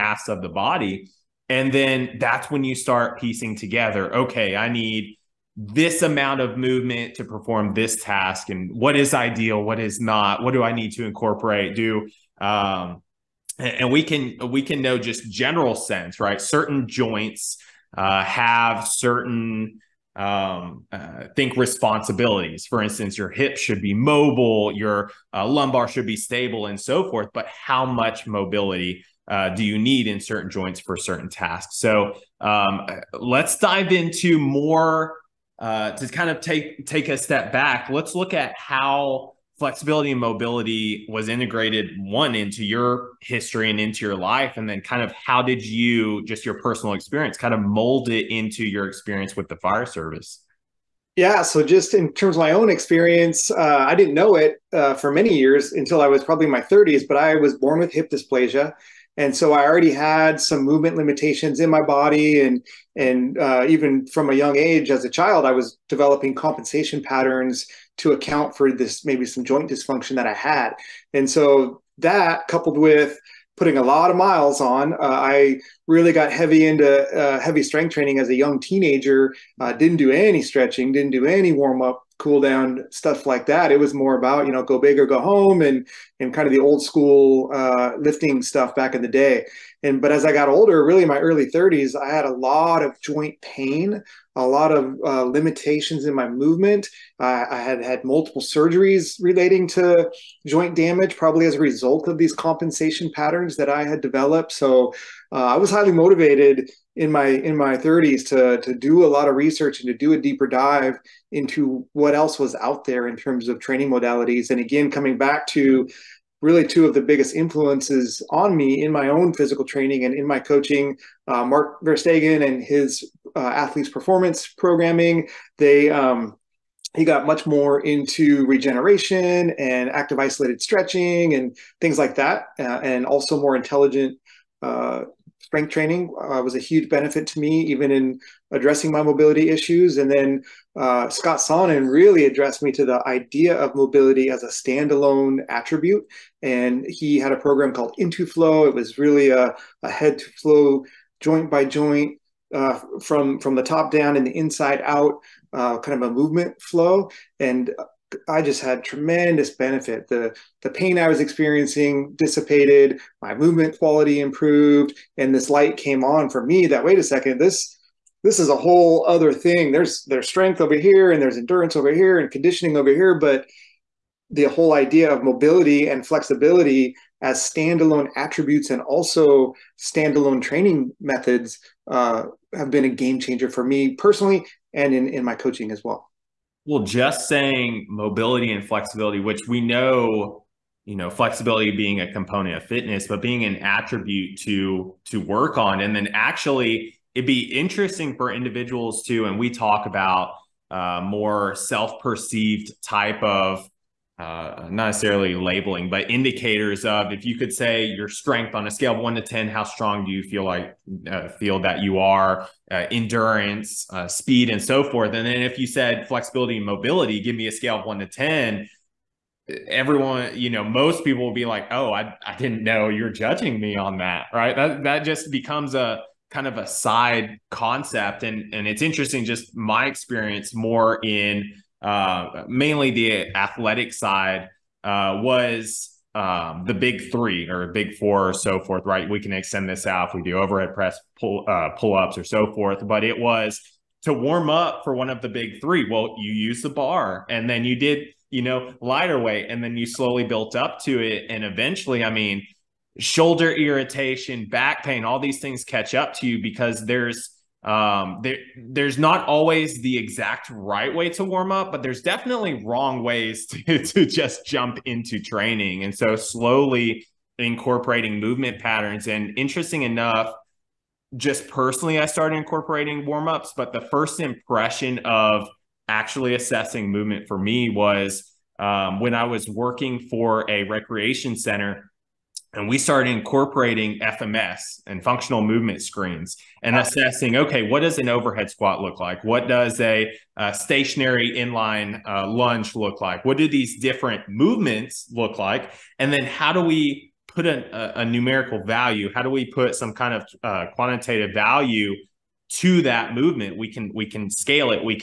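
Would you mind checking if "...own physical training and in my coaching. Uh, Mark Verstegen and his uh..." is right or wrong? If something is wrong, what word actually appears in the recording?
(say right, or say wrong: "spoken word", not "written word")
right.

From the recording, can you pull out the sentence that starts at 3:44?
That that just becomes a kind of a side concept, and and it's interesting.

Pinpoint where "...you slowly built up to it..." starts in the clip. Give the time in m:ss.
4:09.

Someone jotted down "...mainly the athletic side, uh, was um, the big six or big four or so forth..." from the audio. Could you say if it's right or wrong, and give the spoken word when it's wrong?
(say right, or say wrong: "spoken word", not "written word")
wrong: "three", not "six".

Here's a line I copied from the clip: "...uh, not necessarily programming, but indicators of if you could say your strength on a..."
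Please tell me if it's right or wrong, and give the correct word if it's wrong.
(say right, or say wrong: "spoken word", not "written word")
wrong: "labeling", not "programming".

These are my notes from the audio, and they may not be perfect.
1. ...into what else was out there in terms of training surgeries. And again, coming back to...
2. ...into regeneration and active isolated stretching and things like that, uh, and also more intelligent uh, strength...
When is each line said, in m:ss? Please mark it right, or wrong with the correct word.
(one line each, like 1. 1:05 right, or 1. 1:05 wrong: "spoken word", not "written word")
1. 1:51 wrong: "modalities", not "surgeries"
2. 2:07 right.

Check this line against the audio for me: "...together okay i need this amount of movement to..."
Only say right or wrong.
right.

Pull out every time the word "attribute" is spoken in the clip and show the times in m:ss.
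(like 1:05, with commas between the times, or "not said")
2:25, 2:58, 3:13.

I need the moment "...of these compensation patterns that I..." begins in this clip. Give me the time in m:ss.
1:42.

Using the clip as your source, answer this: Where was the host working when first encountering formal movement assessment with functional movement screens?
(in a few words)
a recreation center.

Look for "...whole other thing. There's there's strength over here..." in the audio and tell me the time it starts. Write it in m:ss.
2:48.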